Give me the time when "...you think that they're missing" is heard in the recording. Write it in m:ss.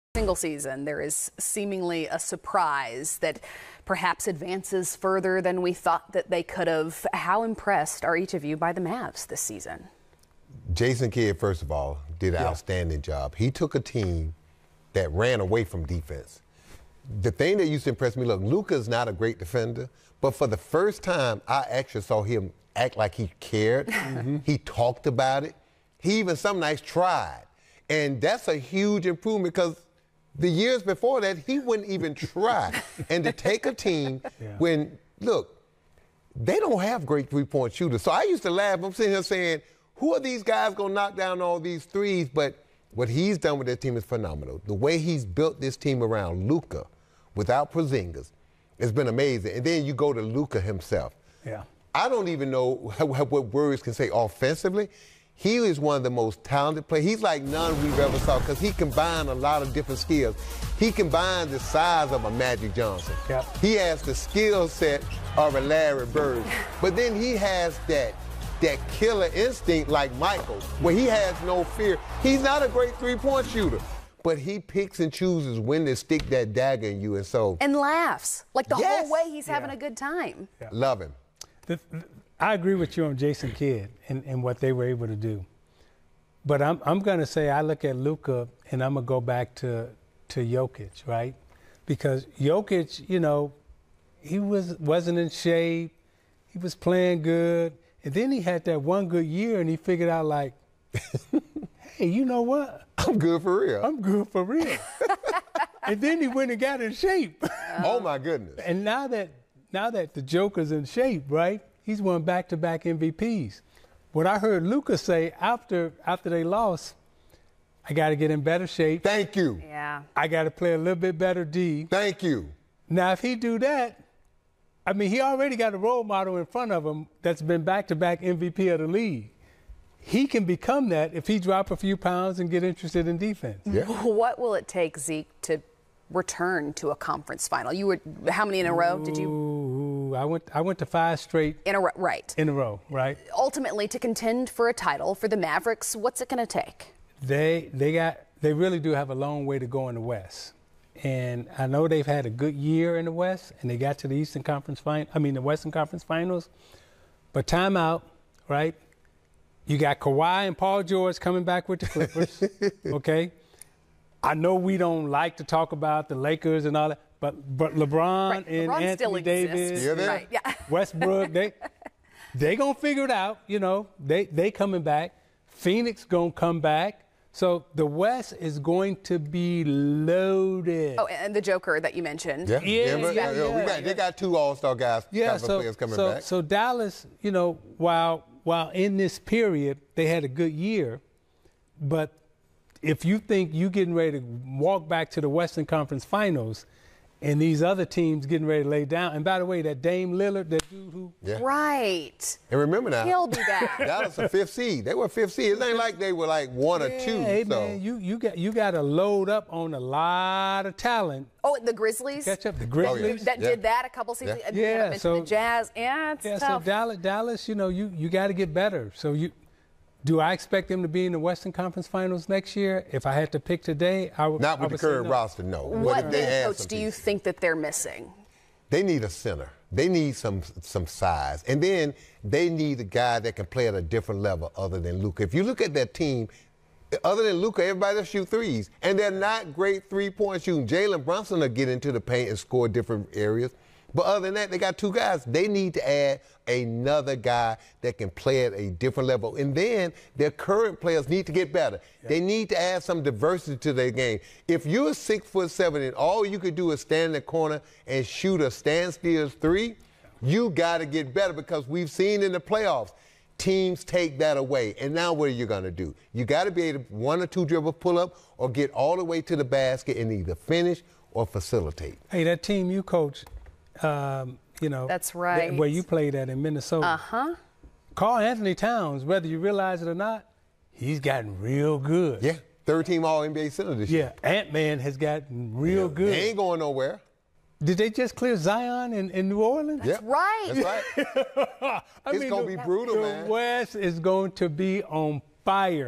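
3:46.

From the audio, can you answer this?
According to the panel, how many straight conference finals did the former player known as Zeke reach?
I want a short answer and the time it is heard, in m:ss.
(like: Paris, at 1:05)
5, at 2:20.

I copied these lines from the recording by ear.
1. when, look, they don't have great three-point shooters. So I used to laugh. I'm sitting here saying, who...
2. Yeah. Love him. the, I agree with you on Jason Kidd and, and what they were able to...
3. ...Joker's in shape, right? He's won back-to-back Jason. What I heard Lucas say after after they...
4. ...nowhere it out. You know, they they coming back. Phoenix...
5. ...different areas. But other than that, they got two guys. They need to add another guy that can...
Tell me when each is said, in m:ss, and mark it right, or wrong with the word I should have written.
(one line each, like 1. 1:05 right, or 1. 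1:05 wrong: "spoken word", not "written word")
1. 0:34 right
2. 1:20 right
3. 1:50 wrong: "MVPs", not "Jason"
4. 2:52 wrong: "figure", not "nowhere"
5. 4:02 right.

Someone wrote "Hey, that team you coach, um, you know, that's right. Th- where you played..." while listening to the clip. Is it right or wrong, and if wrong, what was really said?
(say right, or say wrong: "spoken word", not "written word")
right.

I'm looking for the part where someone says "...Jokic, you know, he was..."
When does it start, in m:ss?
1:32.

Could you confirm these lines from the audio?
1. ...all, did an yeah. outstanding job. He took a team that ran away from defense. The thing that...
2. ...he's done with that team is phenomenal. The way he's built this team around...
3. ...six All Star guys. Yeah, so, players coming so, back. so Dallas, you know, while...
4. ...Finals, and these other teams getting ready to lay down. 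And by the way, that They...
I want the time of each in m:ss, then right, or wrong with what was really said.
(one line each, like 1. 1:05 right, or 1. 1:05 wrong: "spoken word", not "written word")
1. 0:11 right
2. 0:43 right
3. 3:04 wrong: "two", not "six"
4. 3:16 wrong: "Dame", not "They".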